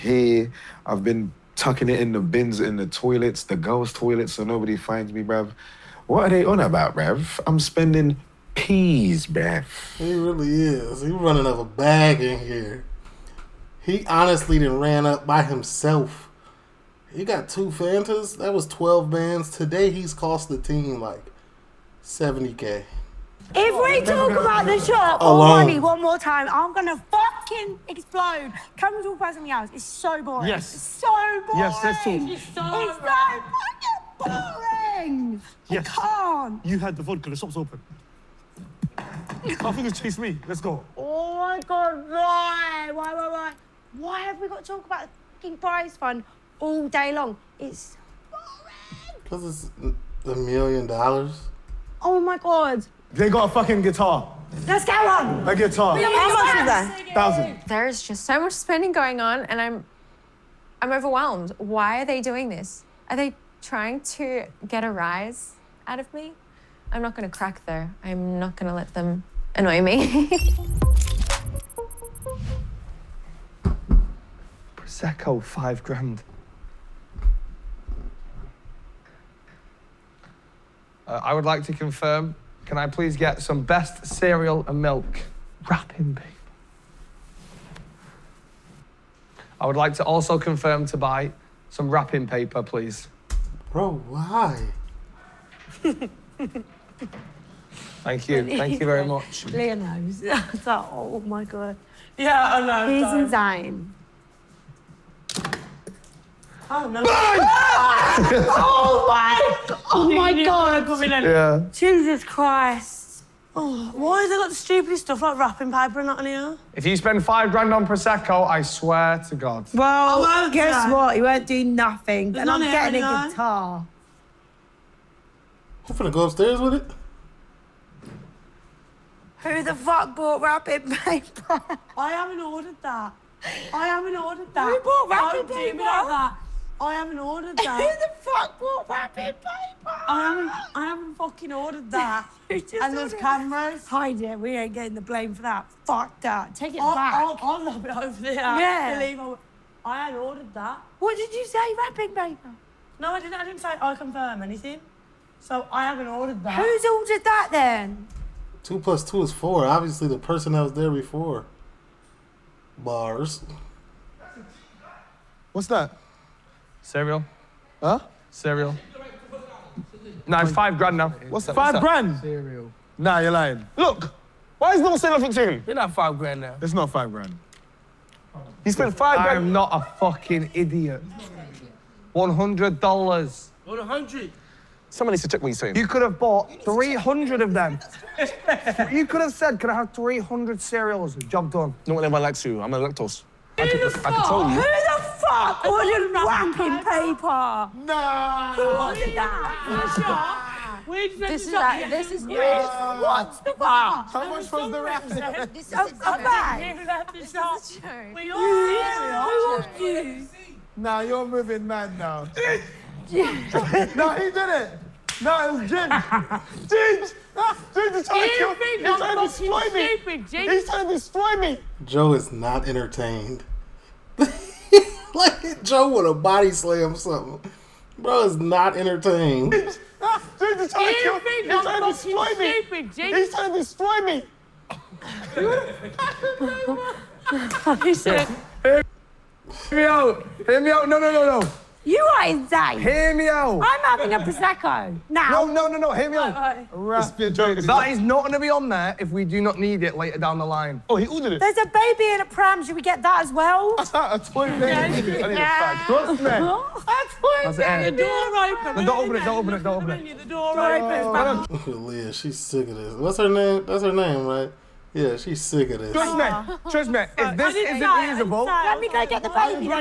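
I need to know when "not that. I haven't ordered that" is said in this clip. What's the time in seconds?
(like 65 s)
135 s.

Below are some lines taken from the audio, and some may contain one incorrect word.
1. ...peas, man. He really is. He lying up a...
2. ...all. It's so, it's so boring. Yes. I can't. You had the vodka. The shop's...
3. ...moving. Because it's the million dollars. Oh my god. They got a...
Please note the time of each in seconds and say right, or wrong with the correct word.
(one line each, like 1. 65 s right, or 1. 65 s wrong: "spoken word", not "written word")
1. 8 s wrong: "running", not "lying"
2. 32 s right
3. 48 s wrong: "boring", not "moving".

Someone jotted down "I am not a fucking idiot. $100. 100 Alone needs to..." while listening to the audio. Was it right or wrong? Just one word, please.
wrong.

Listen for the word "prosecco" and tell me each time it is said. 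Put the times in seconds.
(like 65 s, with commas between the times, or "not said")
74 s, 117 s, 244 s.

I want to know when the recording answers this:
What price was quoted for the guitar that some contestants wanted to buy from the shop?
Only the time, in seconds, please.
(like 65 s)
57 s.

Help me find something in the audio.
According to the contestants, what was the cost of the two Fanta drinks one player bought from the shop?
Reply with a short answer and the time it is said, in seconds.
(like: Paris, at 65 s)
12 bands, at 18 s.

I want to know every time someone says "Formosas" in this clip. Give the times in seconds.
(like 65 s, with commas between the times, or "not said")
not said.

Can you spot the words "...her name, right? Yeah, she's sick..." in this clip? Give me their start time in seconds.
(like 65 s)
263 s.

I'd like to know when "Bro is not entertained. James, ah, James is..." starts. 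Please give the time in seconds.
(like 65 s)
227 s.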